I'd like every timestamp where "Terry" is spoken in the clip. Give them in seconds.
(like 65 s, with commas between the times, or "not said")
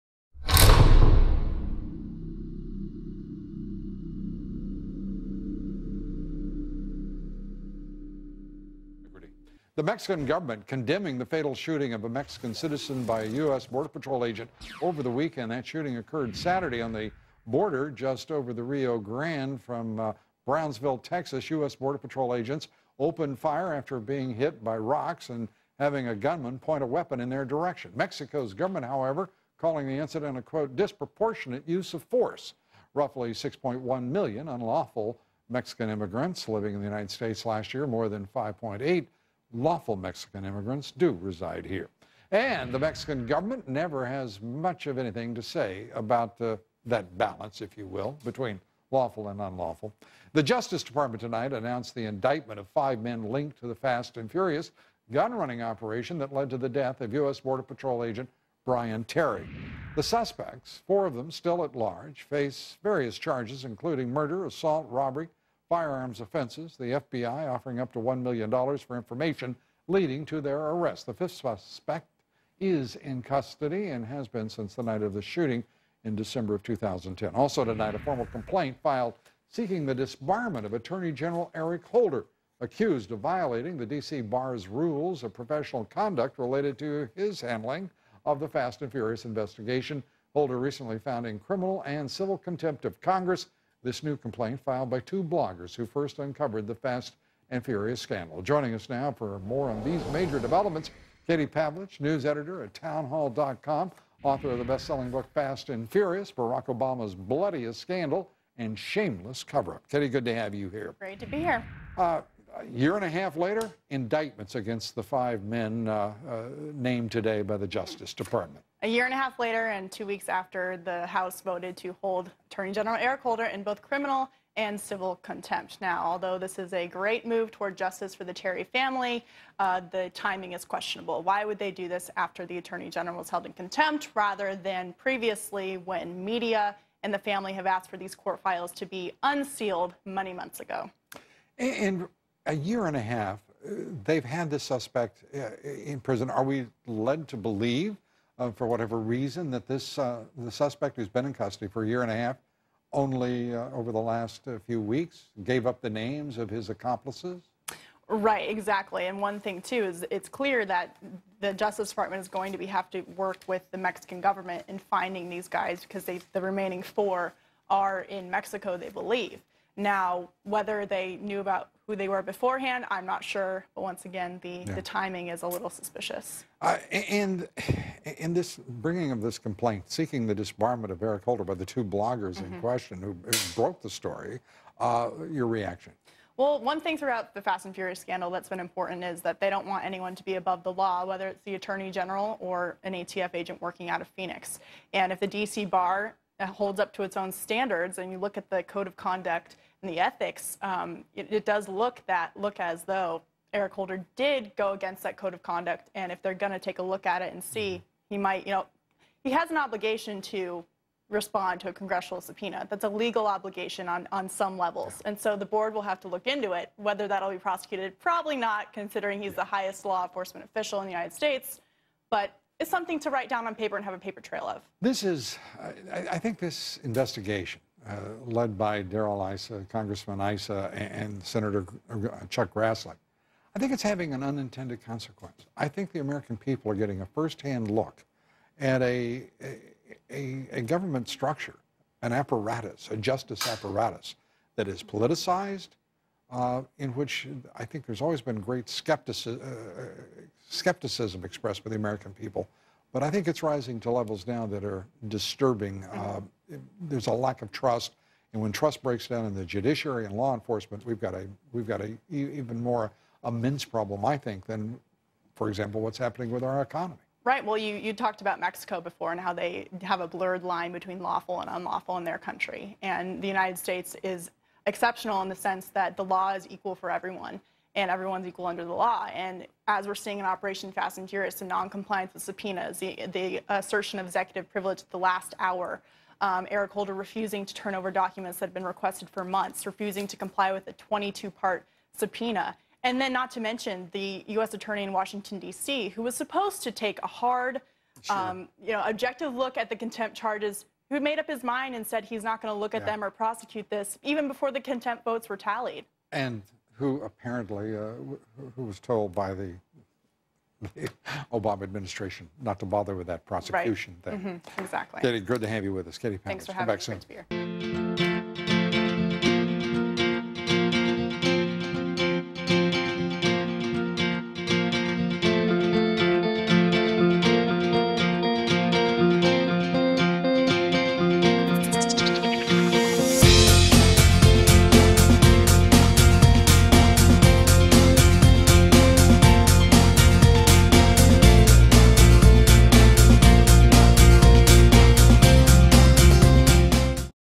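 59 s, 128 s.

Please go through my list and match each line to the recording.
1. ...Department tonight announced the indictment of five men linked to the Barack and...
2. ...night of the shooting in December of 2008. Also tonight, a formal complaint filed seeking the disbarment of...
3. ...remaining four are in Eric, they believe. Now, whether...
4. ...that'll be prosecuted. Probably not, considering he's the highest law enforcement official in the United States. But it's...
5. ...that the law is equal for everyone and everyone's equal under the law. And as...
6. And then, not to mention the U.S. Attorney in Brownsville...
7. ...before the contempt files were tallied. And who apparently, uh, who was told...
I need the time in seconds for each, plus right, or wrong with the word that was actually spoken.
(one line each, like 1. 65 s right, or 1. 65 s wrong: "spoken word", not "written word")
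1. 50 s wrong: "Fast", not "Barack"
2. 74 s wrong: "2010", not "2008"
3. 166 s wrong: "Mexico", not "Eric"
4. 217 s right
5. 275 s right
6. 292 s wrong: "Washington", not "Brownsville"
7. 304 s wrong: "votes", not "files".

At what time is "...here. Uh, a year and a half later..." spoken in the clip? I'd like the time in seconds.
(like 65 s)
111 s.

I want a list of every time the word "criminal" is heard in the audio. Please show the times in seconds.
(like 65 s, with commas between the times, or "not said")
91 s, 123 s.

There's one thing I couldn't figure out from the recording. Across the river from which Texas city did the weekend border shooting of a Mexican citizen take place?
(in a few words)
Brownsville.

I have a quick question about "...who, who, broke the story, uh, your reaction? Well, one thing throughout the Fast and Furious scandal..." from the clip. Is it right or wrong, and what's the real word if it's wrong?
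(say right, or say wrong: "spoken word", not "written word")
right.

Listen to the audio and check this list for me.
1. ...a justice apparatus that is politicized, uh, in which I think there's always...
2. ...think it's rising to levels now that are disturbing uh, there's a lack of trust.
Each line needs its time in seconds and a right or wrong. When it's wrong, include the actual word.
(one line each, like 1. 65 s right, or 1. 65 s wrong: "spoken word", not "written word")
1. 242 s right
2. 253 s right.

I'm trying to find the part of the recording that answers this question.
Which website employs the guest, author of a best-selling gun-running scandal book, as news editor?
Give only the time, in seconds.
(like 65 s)
102 s.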